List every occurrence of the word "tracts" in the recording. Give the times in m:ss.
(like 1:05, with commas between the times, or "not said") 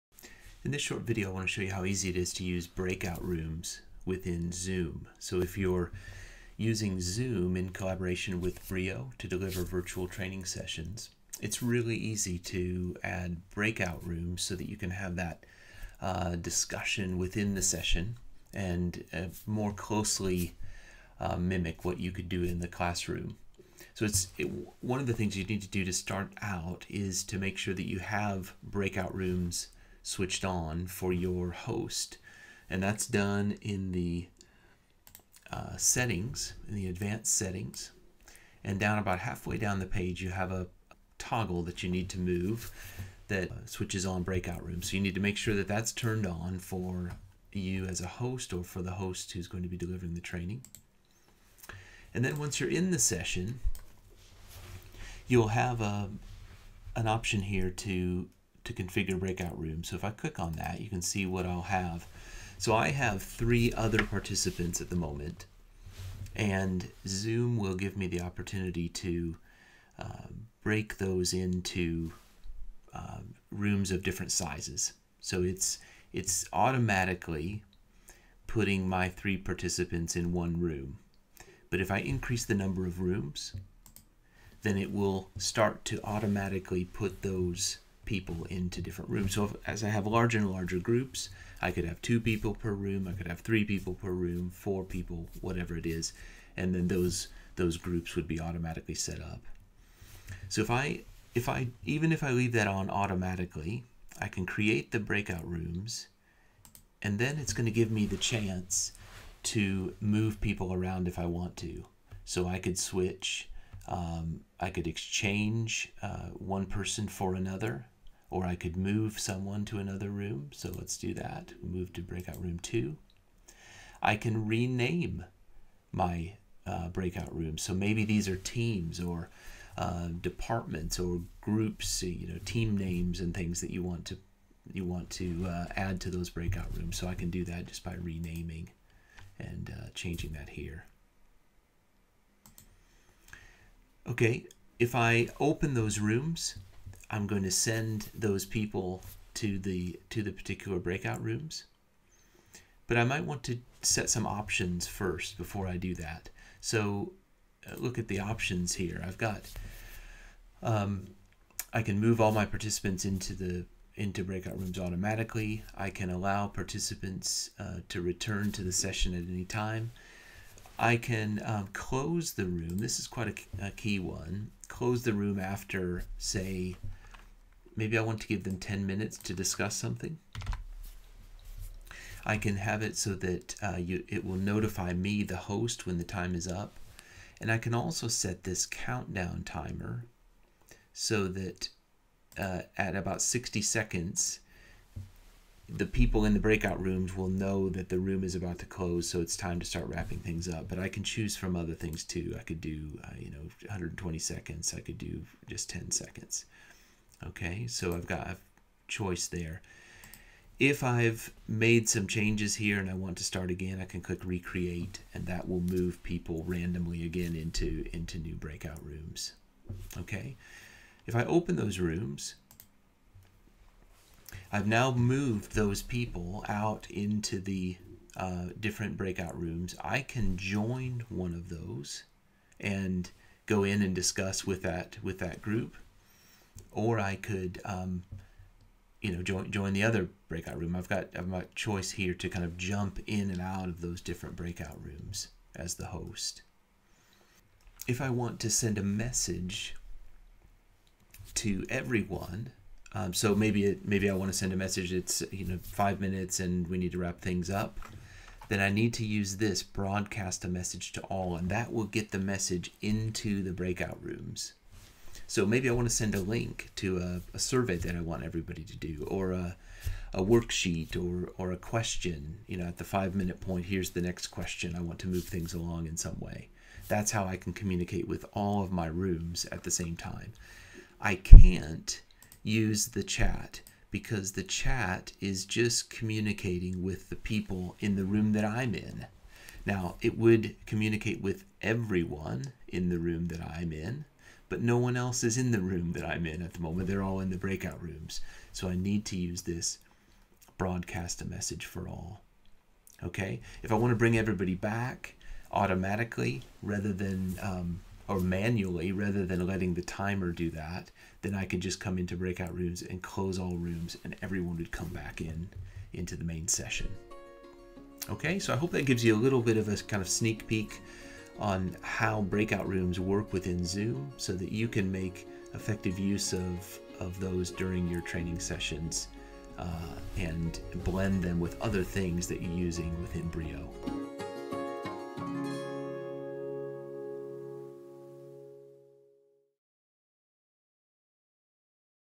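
not said.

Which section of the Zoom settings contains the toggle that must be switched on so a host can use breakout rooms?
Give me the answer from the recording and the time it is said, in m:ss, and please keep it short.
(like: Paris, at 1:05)
advanced settings, at 0:36.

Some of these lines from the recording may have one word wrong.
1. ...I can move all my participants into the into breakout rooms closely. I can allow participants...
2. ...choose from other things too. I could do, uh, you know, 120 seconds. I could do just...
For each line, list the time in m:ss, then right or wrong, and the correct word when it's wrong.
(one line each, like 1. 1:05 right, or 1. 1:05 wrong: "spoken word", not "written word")
1. 2:41 wrong: "automatically", not "closely"
2. 3:21 right.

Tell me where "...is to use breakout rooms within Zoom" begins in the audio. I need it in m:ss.
0:02.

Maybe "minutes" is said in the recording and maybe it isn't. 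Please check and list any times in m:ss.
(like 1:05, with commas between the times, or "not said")
2:58, 4:15, 4:33.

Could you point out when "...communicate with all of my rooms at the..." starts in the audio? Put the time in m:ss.
4:37.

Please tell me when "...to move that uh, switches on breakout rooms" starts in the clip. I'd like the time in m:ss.
0:42.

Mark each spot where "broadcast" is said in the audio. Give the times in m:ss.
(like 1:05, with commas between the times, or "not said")
4:19, 5:00.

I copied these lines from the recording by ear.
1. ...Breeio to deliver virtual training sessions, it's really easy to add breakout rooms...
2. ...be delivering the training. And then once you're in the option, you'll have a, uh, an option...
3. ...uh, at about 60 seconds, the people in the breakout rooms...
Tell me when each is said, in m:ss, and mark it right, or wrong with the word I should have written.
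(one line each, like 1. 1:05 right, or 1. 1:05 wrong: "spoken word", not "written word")
1. 0:08 right
2. 0:49 wrong: "session", not "option"
3. 3:12 right.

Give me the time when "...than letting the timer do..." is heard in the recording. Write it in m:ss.
5:09.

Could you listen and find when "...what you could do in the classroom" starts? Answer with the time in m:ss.
0:21.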